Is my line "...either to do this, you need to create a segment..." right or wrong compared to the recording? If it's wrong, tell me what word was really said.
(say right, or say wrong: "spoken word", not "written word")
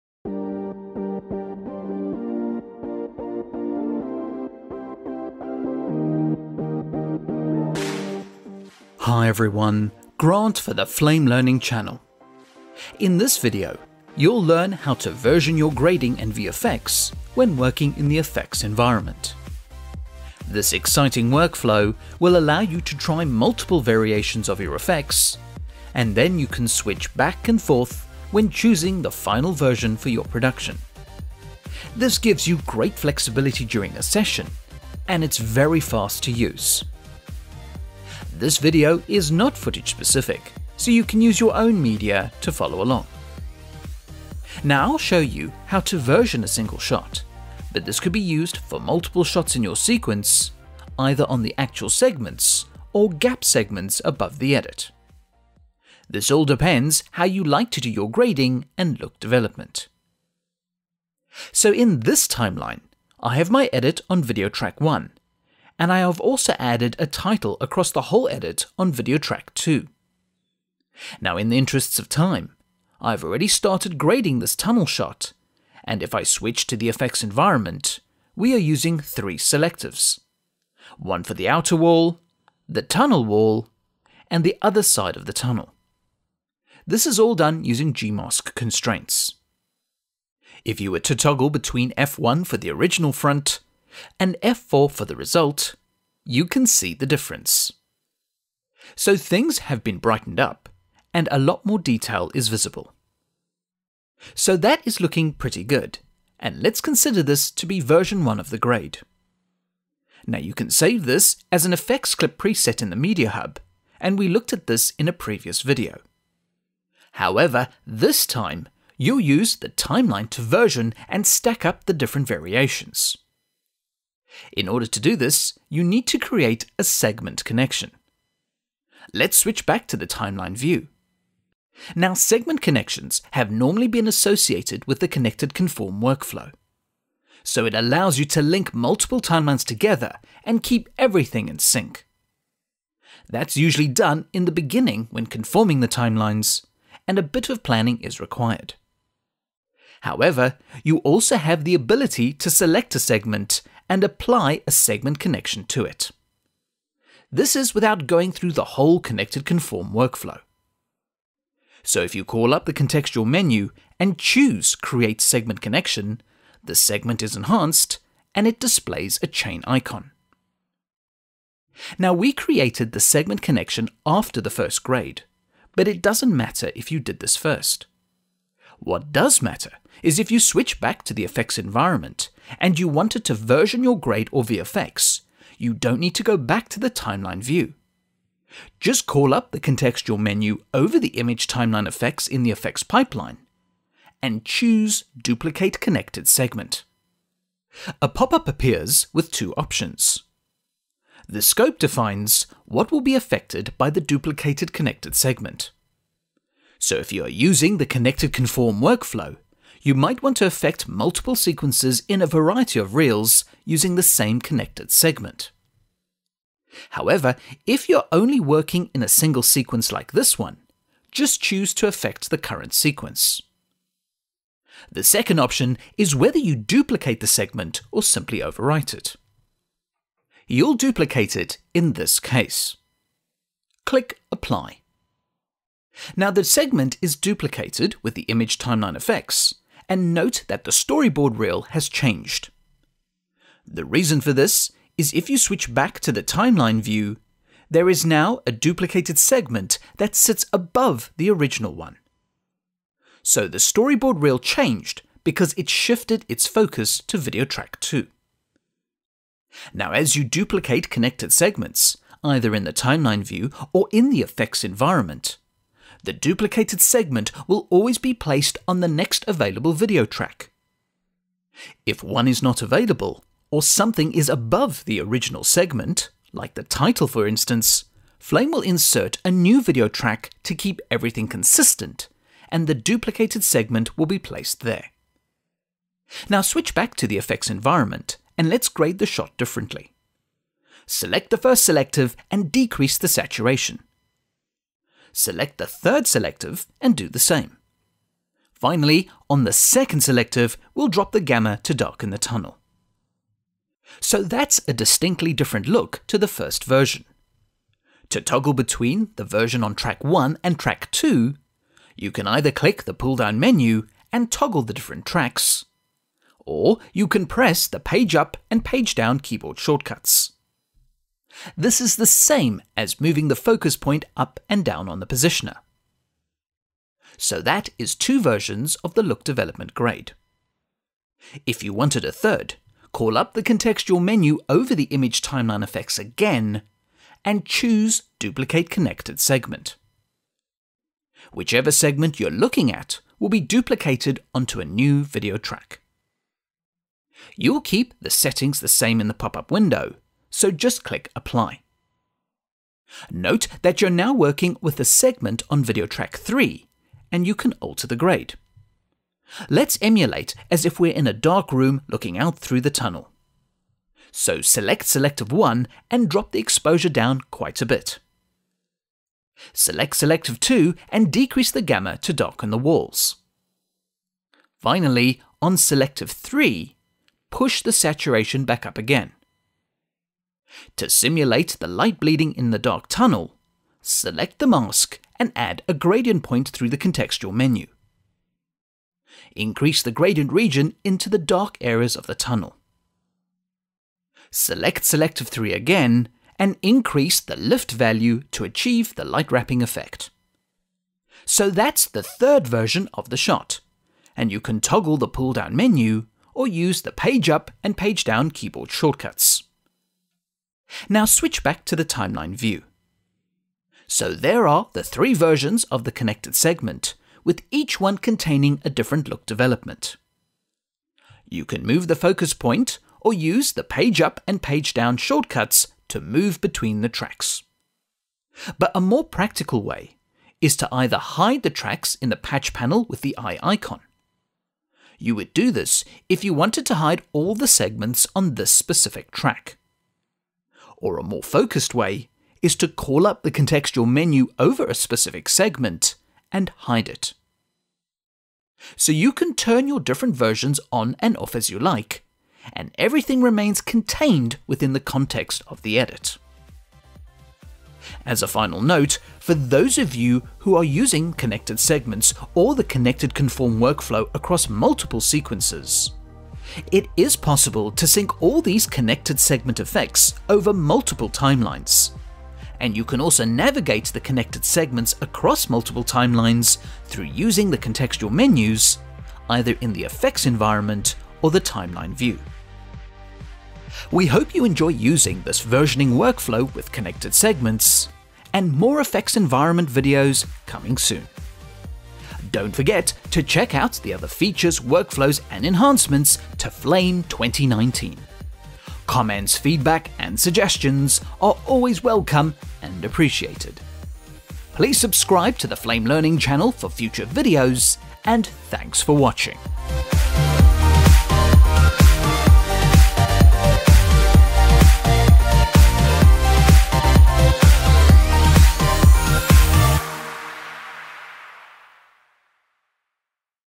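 wrong: "order", not "either".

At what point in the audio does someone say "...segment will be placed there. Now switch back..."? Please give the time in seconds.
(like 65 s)
283 s.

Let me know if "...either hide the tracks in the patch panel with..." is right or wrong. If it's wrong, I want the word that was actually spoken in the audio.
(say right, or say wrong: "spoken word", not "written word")
right.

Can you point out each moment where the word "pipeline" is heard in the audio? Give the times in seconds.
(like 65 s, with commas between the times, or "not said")
192 s.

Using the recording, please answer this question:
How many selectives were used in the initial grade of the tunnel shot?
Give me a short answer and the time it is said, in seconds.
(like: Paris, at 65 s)
3, at 78 s.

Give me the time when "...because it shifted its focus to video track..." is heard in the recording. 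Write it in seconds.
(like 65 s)
255 s.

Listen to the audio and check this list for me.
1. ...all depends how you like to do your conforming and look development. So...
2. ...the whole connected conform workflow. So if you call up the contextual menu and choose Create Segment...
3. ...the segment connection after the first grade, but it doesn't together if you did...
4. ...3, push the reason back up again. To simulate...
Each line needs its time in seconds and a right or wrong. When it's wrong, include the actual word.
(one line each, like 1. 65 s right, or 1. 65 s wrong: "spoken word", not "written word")
1. 56 s wrong: "grading", not "conforming"
2. 158 s right
3. 172 s wrong: "matter", not "together"
4. 376 s wrong: "saturation", not "reason".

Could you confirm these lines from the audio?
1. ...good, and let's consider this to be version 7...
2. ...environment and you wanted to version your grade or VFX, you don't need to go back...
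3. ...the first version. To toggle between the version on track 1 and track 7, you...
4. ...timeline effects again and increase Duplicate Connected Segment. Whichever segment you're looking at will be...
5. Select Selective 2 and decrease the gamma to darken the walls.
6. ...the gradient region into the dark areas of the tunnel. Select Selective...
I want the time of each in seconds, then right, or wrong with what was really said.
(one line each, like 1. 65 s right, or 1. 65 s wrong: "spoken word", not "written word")
1. 105 s wrong: "1", not "7"
2. 181 s right
3. 306 s wrong: "2", not "7"
4. 335 s wrong: "choose", not "increase"
5. 369 s right
6. 389 s right.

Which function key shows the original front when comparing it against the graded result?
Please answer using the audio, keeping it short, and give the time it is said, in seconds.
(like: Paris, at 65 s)
F1, at 91 s.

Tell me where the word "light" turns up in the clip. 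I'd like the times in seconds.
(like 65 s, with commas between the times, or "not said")
381 s, 399 s.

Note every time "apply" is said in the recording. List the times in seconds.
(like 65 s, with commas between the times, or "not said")
154 s, 234 s, 351 s.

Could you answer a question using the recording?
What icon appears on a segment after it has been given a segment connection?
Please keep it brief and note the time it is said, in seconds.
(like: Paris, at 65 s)
Chain icon, at 169 s.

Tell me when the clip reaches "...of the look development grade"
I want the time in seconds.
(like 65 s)
328 s.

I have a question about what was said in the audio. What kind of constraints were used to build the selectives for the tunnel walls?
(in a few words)
Gmask.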